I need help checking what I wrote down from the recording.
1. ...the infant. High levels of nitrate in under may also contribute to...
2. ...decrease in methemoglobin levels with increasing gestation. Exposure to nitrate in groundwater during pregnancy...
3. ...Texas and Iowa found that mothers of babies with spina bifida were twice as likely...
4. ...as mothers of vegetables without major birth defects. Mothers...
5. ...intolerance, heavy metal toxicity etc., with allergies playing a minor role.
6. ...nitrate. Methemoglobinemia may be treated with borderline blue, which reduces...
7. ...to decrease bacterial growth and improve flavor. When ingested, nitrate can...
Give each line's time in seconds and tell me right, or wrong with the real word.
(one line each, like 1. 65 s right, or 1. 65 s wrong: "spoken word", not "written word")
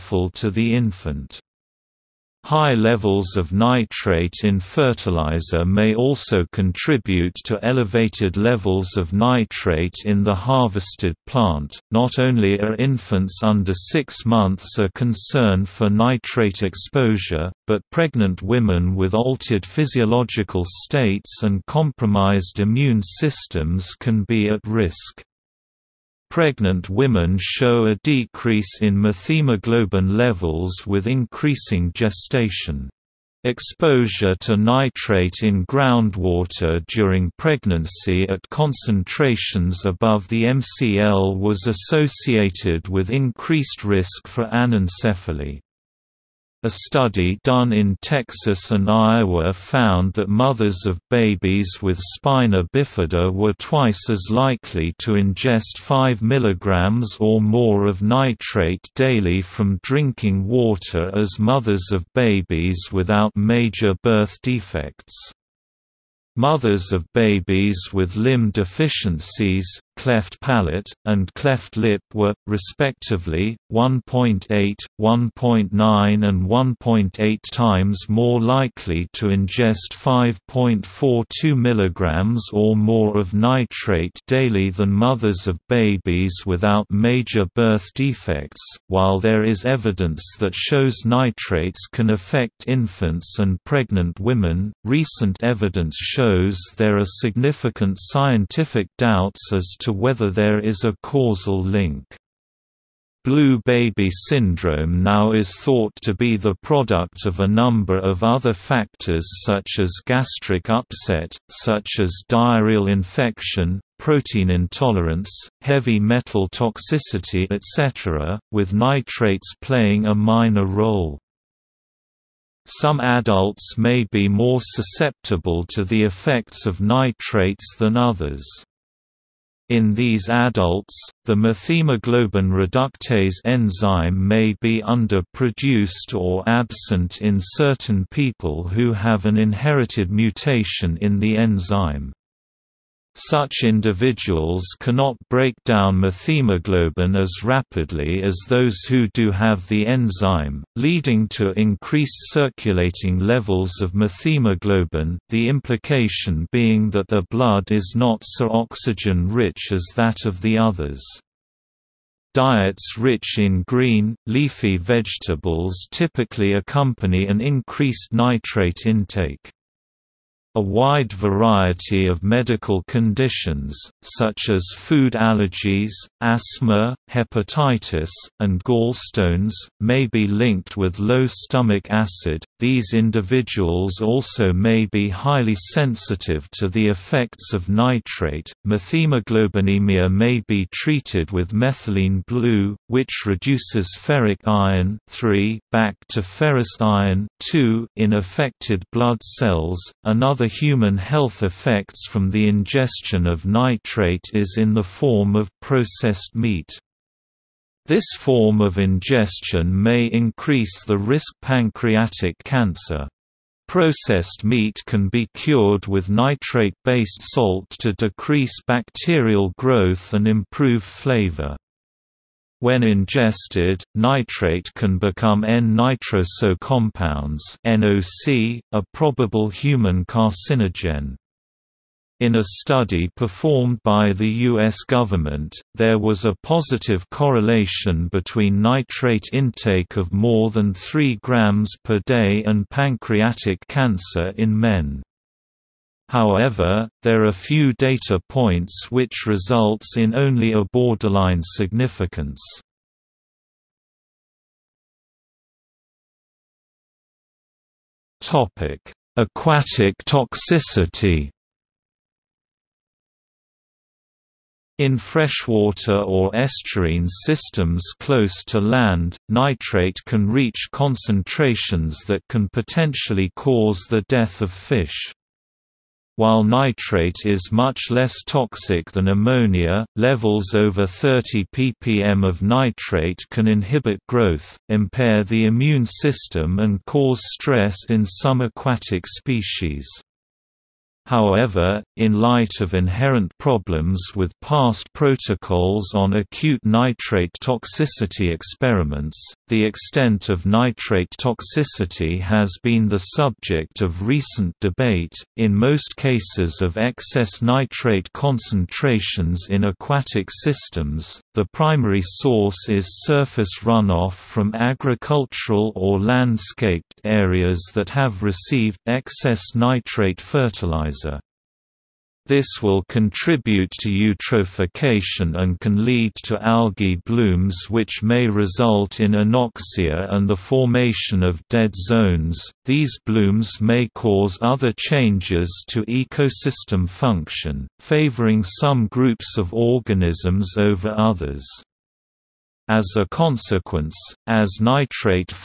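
1. 0 s wrong: "fertilizer", not "under"
2. 28 s right
3. 48 s right
4. 61 s wrong: "babies", not "vegetables"
5. 114 s wrong: "nitrates", not "allergies"
6. 187 s wrong: "methylene", not "borderline"
7. 217 s right.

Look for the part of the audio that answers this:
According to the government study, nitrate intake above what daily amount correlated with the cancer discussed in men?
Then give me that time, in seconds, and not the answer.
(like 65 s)
240 s.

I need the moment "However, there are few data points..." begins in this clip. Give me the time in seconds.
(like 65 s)
246 s.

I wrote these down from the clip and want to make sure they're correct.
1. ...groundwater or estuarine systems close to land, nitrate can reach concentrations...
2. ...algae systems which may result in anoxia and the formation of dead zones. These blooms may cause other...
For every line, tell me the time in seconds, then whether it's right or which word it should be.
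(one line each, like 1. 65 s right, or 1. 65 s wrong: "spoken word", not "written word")
1. 264 s wrong: "freshwater", not "groundwater"
2. 326 s wrong: "blooms", not "systems".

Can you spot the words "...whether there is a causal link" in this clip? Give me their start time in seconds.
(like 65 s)
99 s.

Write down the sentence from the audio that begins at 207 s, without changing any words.
This form of ingestion may increase the risk pancreatic cancer.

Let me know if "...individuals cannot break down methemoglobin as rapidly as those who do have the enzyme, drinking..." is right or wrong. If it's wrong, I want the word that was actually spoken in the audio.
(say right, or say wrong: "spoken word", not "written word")
wrong: "leading", not "drinking".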